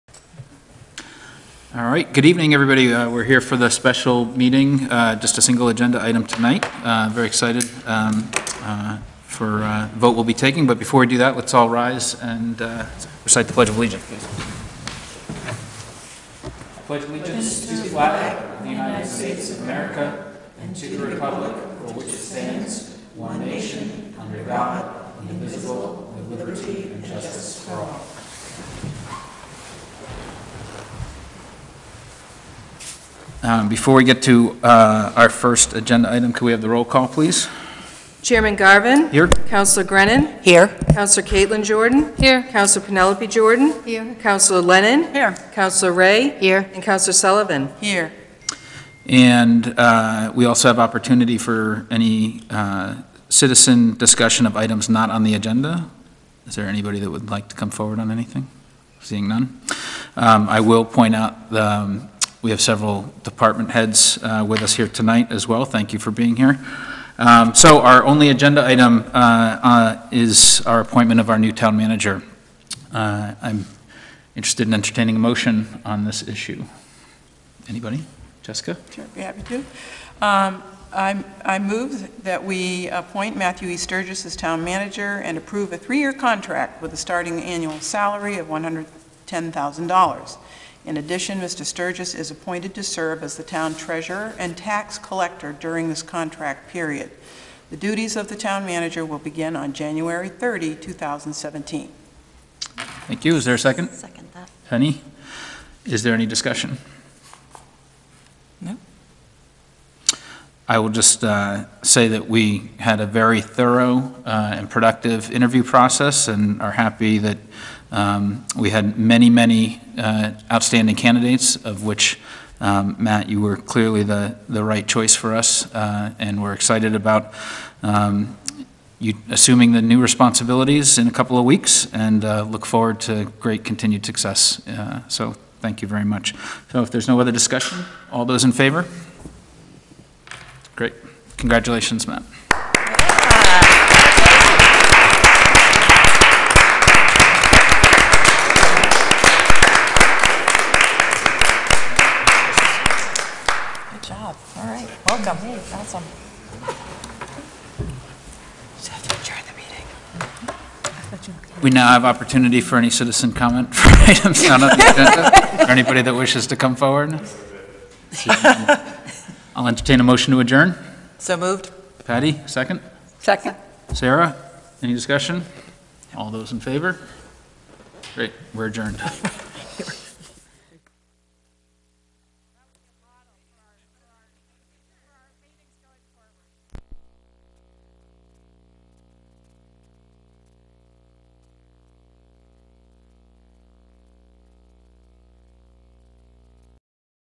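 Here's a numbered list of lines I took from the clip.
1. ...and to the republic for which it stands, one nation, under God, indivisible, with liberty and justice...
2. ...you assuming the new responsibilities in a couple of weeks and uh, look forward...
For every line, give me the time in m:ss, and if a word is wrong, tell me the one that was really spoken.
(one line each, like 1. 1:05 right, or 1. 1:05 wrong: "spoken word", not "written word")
1. 0:20 right
2. 2:08 right.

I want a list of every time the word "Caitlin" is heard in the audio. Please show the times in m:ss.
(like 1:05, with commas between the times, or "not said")
0:41.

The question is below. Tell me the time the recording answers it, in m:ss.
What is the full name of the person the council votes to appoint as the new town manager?
1:23.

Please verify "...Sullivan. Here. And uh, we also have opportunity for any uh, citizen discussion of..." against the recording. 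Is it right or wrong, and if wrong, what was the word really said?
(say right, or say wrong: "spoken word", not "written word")
right.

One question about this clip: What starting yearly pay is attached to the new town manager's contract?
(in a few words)
$110,000.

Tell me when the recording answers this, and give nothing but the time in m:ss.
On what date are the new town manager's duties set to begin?
1:39.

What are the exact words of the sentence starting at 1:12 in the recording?
Uh, I'm interested in entertaining a motion on this issue.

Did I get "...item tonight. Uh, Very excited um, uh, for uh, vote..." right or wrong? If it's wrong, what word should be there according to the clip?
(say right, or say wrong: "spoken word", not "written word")
right.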